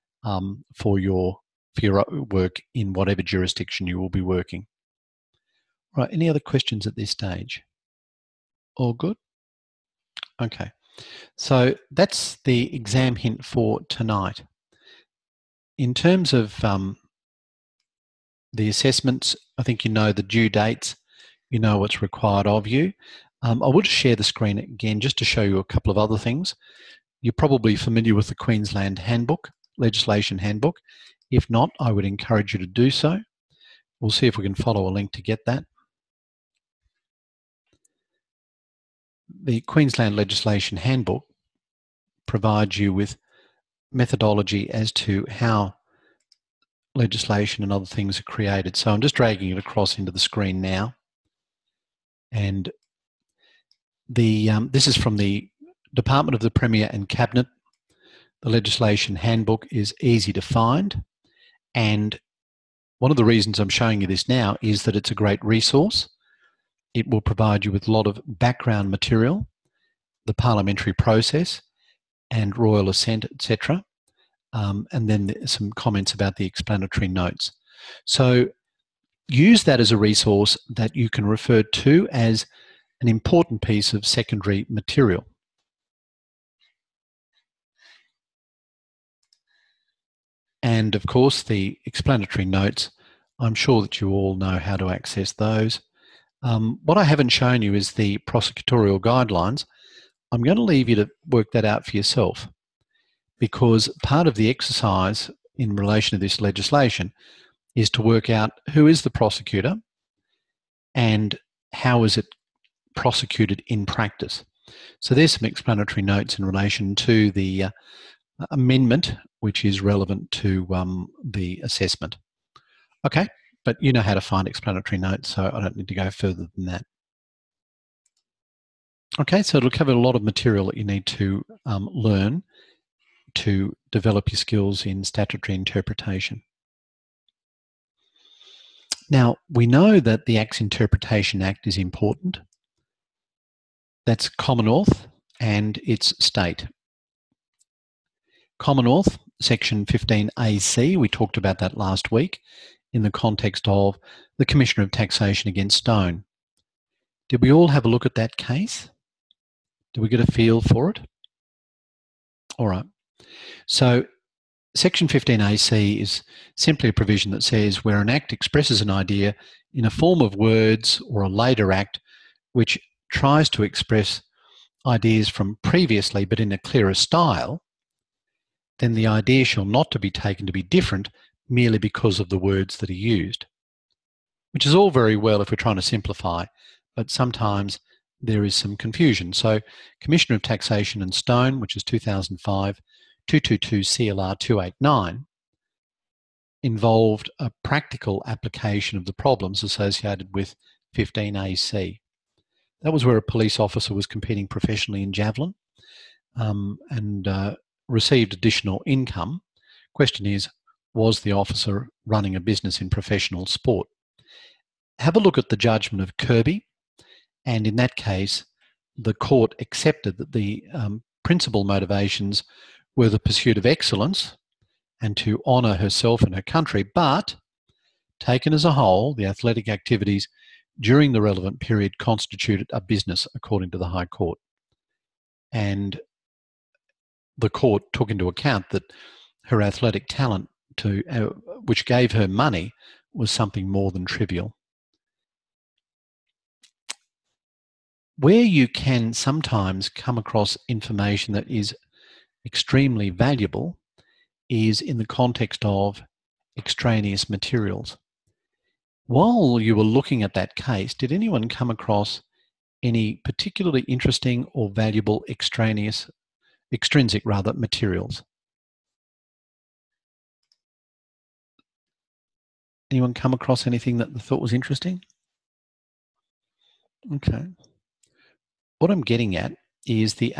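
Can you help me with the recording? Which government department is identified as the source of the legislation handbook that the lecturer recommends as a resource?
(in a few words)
Department of the Premier and Cabinet.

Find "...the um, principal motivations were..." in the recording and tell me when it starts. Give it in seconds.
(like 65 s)
220 s.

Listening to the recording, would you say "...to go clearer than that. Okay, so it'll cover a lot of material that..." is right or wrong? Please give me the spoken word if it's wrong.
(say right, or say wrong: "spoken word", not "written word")
wrong: "further", not "clearer".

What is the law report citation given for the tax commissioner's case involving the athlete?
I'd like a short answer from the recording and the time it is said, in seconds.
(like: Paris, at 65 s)
2005 222 CLR 289, at 191 s.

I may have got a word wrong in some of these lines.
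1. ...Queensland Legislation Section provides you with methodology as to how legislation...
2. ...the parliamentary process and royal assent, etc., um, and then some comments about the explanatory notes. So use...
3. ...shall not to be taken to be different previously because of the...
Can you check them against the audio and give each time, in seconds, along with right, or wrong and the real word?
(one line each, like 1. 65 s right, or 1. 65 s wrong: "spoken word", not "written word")
1. 39 s wrong: "Handbook", not "Section"
2. 70 s right
3. 179 s wrong: "merely", not "previously".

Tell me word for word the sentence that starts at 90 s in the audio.
And of course, the explanatory notes, I'm sure that you all know how to access those.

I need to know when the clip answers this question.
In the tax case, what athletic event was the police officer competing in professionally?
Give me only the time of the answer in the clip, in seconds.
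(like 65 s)
205 s.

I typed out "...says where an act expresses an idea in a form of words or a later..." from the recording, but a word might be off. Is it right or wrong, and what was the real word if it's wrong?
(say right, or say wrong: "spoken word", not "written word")
right.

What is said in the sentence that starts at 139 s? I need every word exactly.
Now, we know that the Acts Interpretation Act is important.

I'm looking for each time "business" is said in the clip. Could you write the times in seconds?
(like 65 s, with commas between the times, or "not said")
212 s, 232 s.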